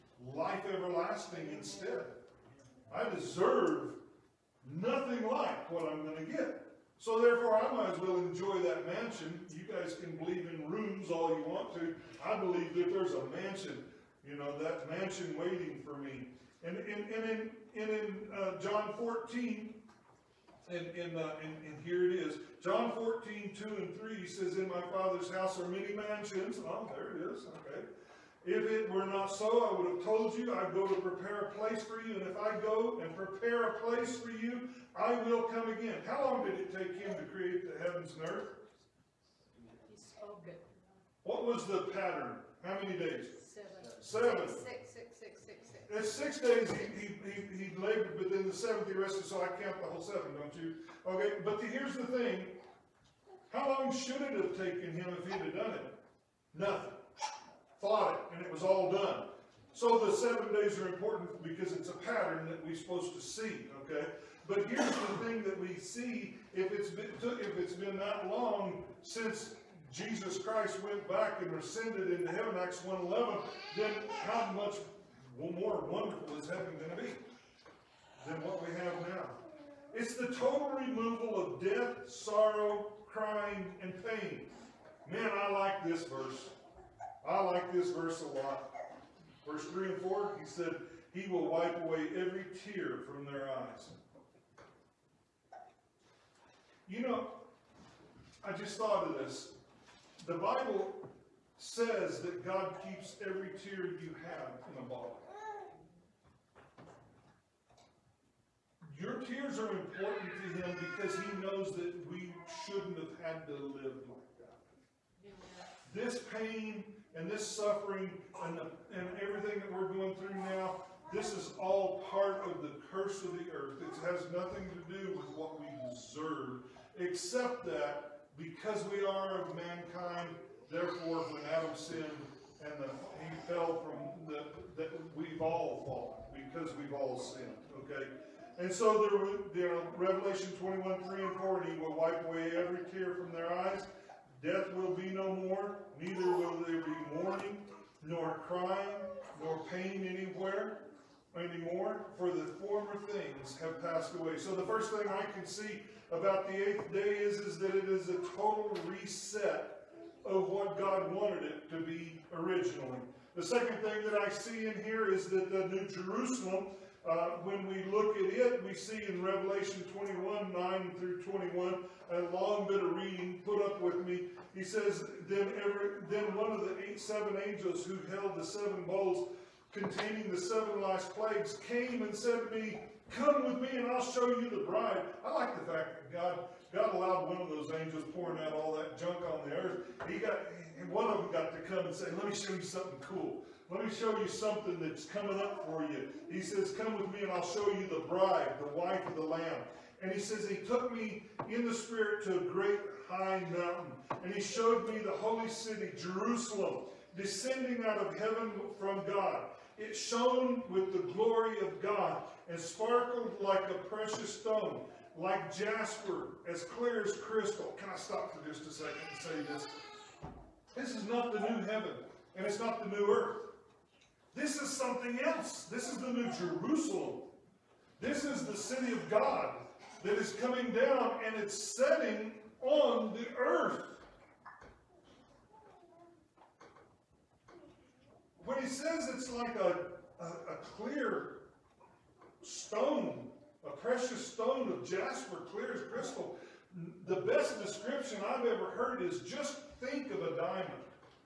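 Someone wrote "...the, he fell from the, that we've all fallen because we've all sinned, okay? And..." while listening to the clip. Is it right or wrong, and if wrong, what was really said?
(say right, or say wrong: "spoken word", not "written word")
right.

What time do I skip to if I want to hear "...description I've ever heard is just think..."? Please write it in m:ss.
4:07.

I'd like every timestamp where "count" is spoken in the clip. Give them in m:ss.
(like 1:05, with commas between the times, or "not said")
0:49.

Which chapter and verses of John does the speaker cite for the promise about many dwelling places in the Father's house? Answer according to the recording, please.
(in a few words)
John 14:2-3.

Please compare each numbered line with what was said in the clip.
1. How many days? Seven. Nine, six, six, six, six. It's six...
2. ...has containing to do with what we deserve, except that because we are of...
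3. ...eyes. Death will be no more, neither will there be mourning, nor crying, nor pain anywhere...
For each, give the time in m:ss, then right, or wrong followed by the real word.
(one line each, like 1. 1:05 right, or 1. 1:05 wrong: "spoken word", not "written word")
1. 0:42 wrong: "Six", not "Nine"
2. 2:04 wrong: "nothing", not "containing"
3. 2:23 right.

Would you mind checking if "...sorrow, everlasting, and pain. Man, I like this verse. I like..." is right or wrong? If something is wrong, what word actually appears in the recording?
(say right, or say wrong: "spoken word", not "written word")
wrong: "crying", not "everlasting".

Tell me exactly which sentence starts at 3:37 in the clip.
Can I stop for just a second and say this?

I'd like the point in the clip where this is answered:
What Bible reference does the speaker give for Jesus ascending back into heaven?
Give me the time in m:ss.
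1:12.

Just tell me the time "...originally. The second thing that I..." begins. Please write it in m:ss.
2:42.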